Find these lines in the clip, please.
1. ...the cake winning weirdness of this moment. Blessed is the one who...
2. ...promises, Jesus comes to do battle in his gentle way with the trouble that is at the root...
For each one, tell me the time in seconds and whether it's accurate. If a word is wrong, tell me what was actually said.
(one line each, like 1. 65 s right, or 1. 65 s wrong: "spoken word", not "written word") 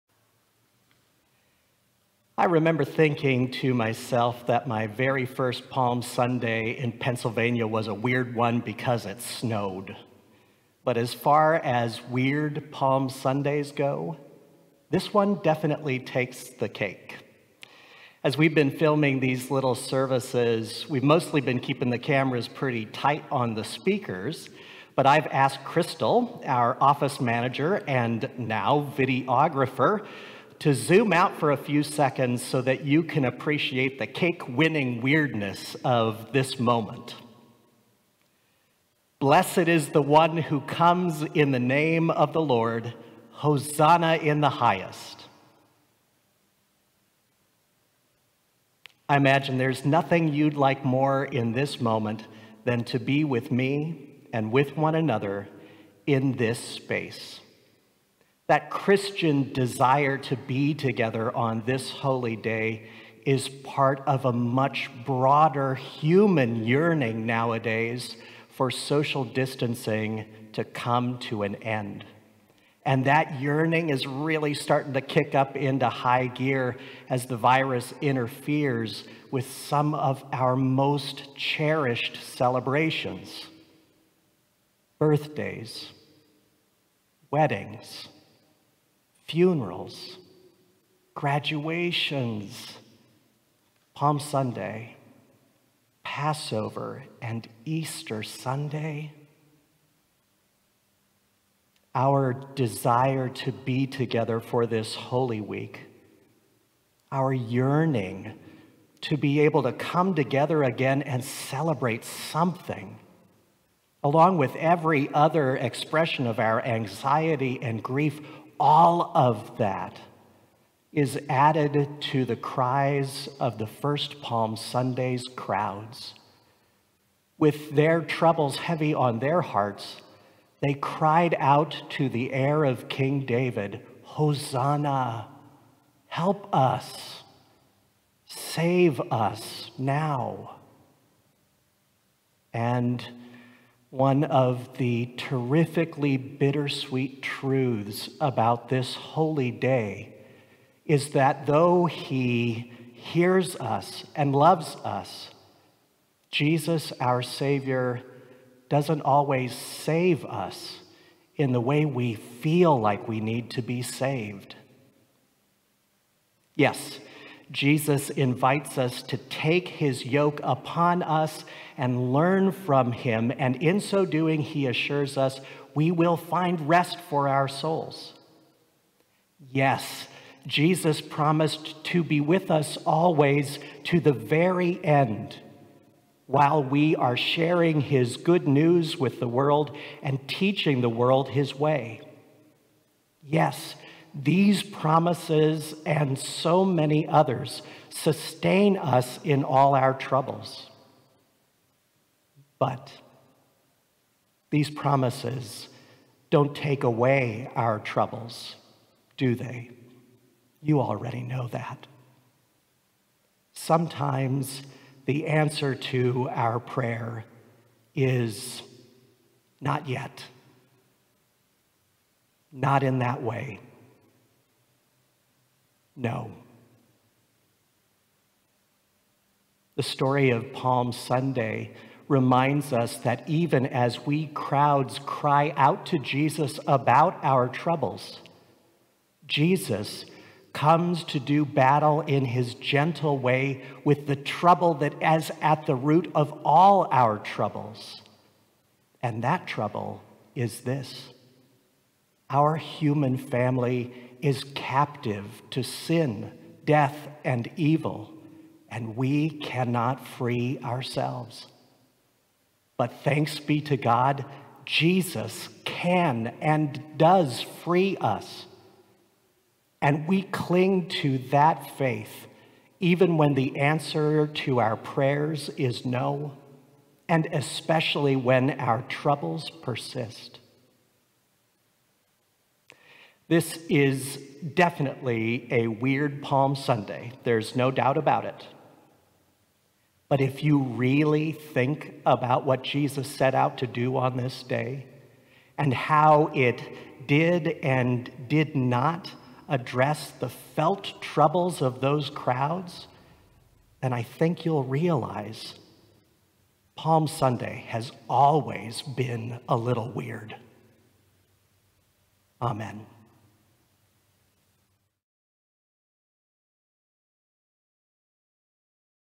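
1. 33 s right
2. 237 s wrong: "troubles", not "promises".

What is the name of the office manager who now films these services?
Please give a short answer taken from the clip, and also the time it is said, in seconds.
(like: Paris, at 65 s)
Crystal, at 25 s.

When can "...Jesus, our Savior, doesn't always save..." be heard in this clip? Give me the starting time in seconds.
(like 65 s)
156 s.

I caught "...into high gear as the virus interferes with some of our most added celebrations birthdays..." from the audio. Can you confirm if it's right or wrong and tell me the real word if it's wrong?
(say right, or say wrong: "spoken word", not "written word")
wrong: "cherished", not "added".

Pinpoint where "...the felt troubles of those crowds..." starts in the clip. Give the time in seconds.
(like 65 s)
300 s.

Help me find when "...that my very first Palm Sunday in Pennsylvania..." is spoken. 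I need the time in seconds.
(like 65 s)
4 s.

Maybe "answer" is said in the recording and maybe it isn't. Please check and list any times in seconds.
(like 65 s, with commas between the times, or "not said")
215 s, 273 s.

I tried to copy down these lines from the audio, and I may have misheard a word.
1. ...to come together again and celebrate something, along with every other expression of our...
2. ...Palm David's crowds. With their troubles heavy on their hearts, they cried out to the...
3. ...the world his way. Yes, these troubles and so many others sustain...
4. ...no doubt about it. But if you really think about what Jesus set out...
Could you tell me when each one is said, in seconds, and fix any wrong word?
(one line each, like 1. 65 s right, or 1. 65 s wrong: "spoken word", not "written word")
1. 109 s right
2. 124 s wrong: "Sunday", not "David"
3. 190 s wrong: "promises", not "troubles"
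4. 287 s right.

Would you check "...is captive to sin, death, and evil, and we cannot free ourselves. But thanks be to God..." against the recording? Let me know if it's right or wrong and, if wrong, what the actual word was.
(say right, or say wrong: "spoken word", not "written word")
right.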